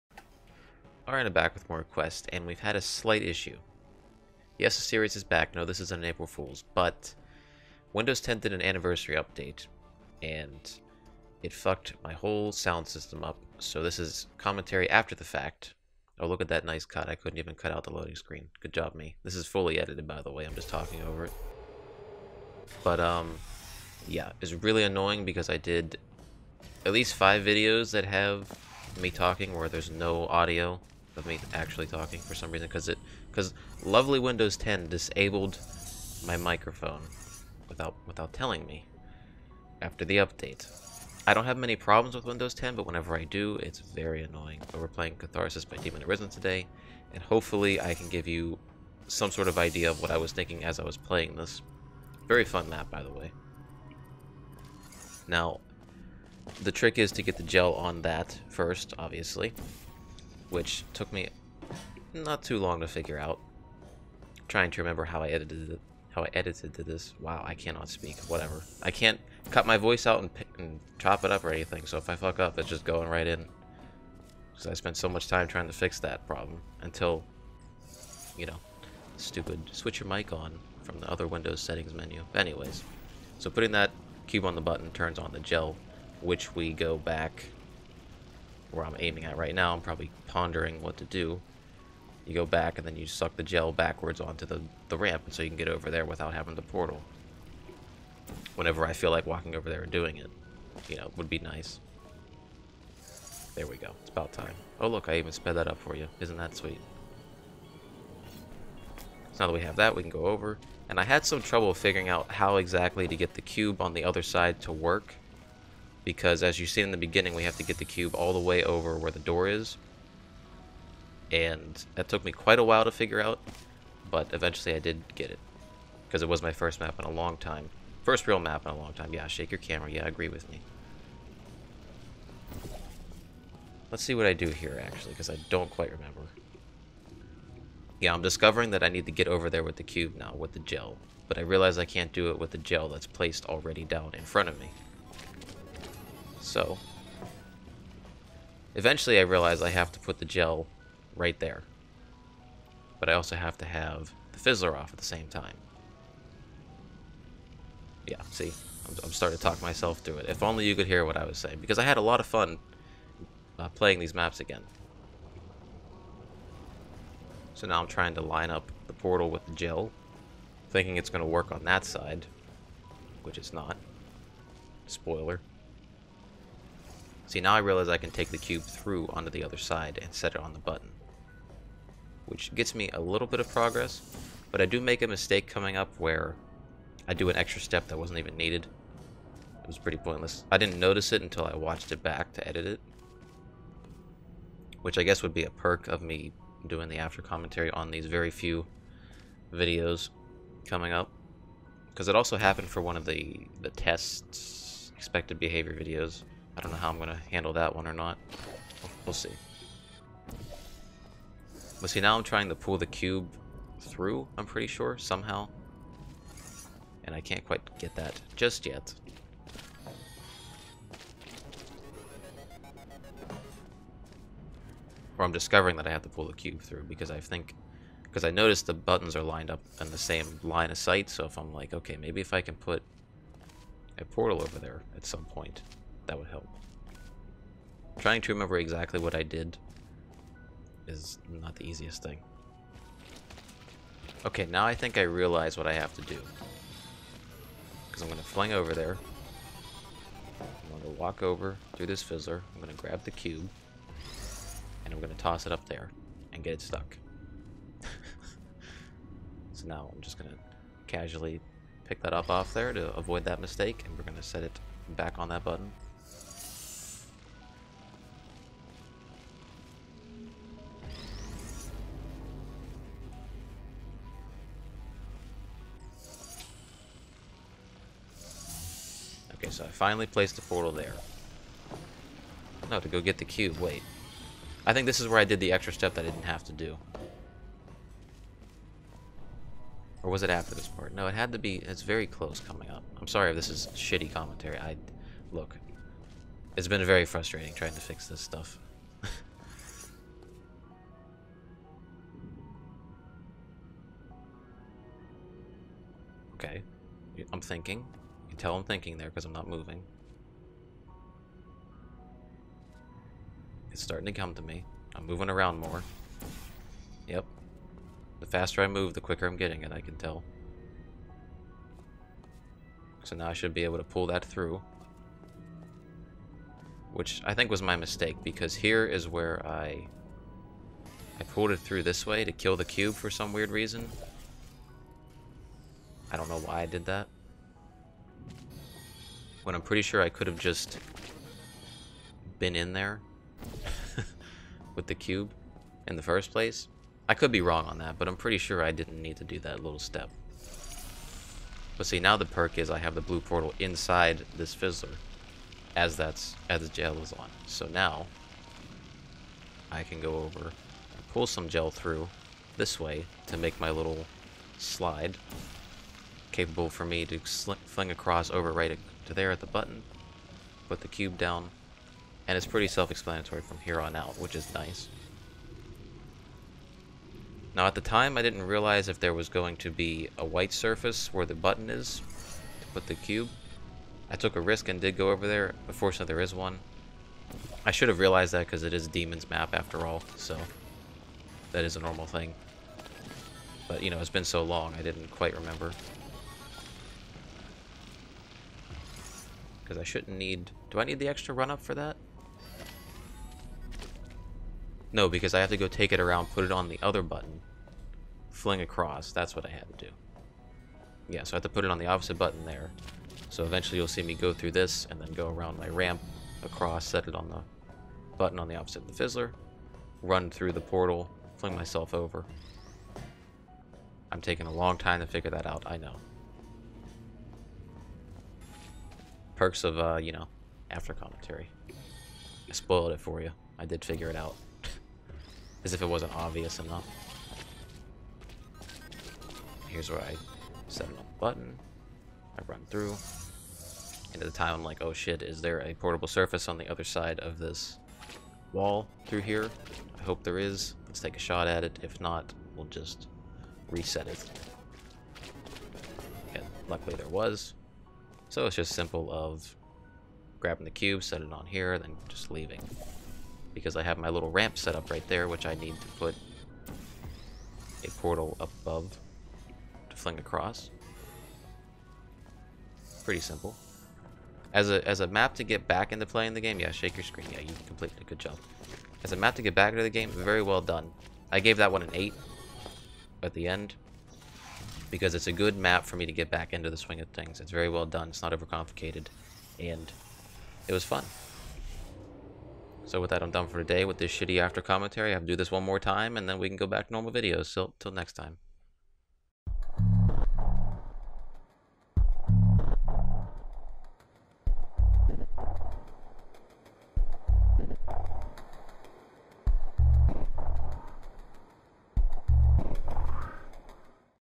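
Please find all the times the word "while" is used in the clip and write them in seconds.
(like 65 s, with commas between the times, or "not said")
122 s.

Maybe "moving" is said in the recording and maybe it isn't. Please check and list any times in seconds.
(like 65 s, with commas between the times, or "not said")
309 s, 315 s.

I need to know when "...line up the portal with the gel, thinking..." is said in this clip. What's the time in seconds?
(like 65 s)
168 s.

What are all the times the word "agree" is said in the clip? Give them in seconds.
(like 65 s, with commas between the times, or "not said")
130 s.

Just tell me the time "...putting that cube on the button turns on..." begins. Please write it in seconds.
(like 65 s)
83 s.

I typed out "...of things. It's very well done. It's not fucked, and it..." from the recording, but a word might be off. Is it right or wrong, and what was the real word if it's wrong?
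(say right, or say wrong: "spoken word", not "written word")
wrong: "overcomplicated", not "fucked".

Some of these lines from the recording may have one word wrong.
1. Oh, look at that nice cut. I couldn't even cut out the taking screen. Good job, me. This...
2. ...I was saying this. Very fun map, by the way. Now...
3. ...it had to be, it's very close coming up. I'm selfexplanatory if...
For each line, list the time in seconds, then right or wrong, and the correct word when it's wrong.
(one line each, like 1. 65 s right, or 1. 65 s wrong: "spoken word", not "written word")
1. 16 s wrong: "loading", not "taking"
2. 50 s wrong: "playing", not "saying"
3. 291 s wrong: "sorry", not "selfexplanatory".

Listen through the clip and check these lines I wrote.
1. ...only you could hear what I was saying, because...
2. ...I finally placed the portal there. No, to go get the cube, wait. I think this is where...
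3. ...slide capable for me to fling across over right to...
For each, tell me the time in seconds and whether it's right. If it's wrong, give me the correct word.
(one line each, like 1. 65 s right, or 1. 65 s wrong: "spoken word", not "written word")
1. 160 s right
2. 279 s right
3. 364 s right.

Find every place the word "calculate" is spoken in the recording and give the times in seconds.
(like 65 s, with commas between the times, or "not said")
not said.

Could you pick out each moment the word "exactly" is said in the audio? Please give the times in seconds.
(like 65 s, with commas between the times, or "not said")
112 s, 238 s.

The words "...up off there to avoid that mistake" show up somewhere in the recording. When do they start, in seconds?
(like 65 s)
262 s.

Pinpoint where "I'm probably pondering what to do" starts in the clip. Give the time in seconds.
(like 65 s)
89 s.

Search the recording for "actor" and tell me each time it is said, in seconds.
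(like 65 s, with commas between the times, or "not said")
not said.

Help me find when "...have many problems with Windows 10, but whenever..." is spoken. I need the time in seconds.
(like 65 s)
41 s.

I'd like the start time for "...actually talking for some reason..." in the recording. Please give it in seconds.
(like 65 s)
31 s.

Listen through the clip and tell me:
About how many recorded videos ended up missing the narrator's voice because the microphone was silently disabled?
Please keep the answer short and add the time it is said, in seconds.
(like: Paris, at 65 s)
5, at 27 s.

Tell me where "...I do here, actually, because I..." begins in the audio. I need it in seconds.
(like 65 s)
134 s.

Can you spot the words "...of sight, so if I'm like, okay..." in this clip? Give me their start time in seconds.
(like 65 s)
230 s.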